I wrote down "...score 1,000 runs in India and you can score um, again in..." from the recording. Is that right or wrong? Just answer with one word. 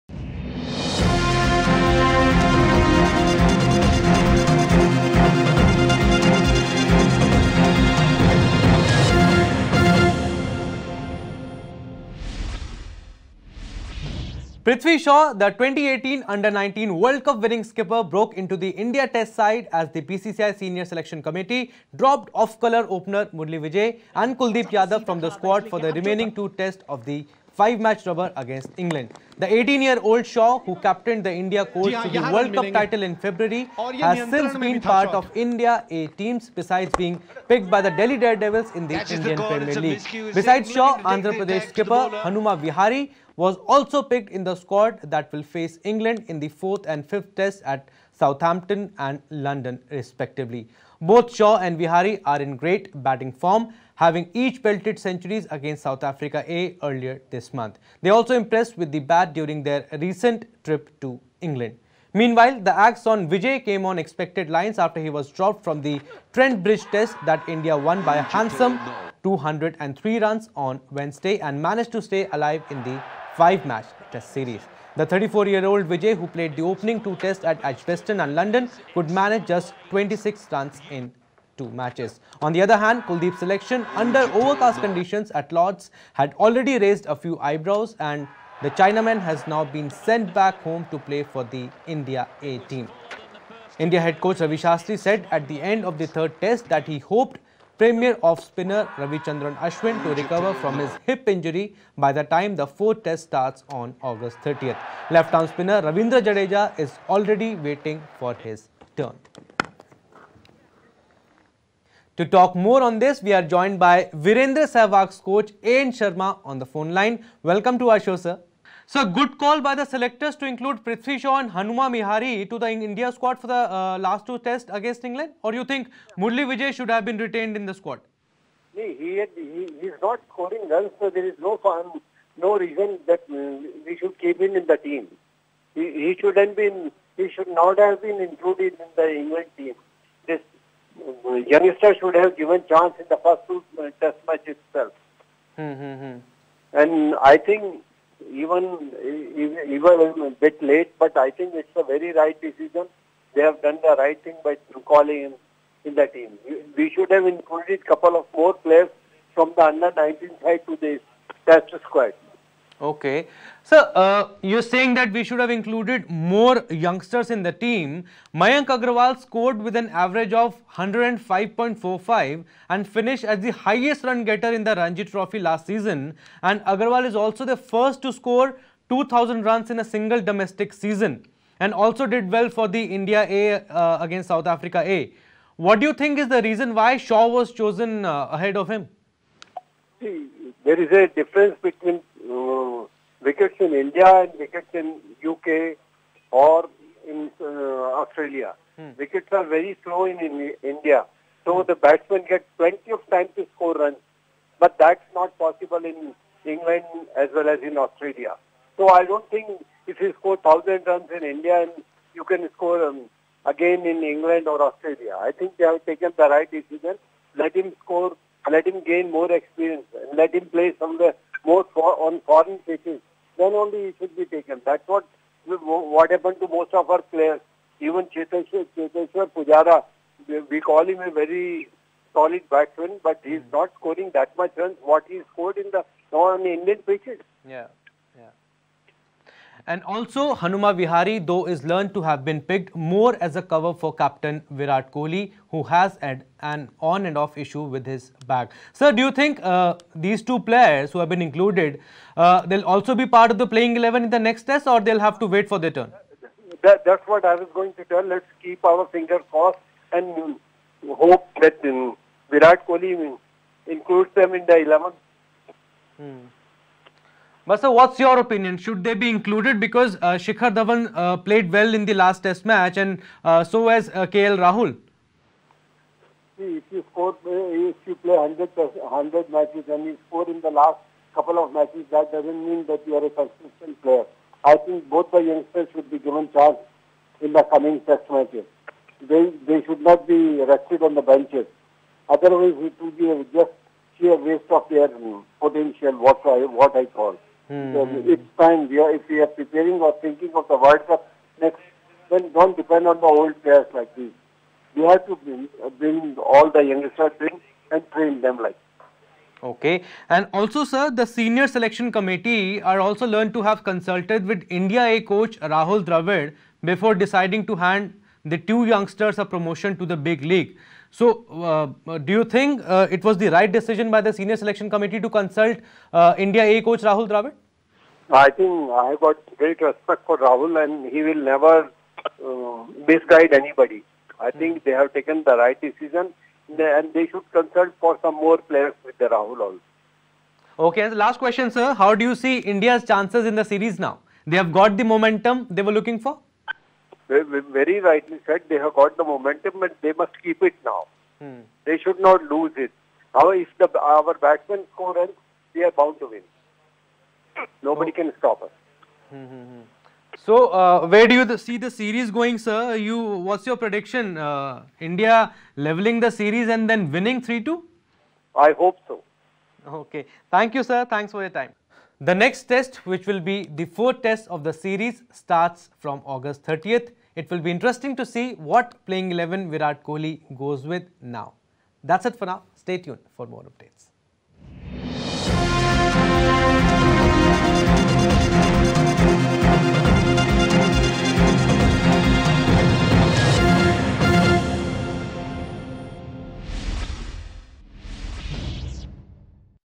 right.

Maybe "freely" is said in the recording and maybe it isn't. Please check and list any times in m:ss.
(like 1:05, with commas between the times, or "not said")
not said.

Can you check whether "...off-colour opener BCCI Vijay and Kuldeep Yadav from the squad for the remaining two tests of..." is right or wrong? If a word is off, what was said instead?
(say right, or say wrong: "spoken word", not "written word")
wrong: "Murali", not "BCCI".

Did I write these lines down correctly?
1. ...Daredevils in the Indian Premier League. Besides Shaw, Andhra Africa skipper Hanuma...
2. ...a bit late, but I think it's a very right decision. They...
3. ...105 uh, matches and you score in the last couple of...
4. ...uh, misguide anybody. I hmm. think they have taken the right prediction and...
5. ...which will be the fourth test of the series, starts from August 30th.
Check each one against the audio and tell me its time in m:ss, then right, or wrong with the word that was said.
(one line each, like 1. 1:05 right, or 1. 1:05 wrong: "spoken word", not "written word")
1. 0:38 wrong: "Pradesh", not "Africa"
2. 2:30 right
3. 4:38 wrong: "100", not "105"
4. 5:32 wrong: "decision", not "prediction"
5. 6:12 right.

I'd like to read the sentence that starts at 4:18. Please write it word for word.
Let's keep our fingers crossed and hope that um, Virat Kohli includes them in the 11.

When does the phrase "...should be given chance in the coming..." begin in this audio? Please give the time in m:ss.
4:45.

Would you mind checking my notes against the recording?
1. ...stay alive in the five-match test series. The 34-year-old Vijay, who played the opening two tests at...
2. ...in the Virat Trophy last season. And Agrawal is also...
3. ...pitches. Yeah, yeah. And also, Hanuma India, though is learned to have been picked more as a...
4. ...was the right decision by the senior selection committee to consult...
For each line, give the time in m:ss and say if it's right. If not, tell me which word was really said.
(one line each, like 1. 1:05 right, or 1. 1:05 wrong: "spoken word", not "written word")
1. 1:12 right
2. 2:54 wrong: "Ranji", not "Virat"
3. 3:56 wrong: "Vihari", not "India"
4. 5:23 right.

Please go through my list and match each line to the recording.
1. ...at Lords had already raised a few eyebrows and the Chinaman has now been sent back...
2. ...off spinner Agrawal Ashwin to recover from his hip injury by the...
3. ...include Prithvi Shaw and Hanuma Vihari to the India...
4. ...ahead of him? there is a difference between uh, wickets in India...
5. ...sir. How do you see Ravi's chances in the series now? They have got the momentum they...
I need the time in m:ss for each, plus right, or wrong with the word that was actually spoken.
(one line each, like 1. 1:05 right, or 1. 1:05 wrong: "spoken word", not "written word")
1. 1:25 right
2. 1:38 wrong: "Ravichandran", not "Agrawal"
3. 2:00 right
4. 3:08 right
5. 5:41 wrong: "India", not "Ravi".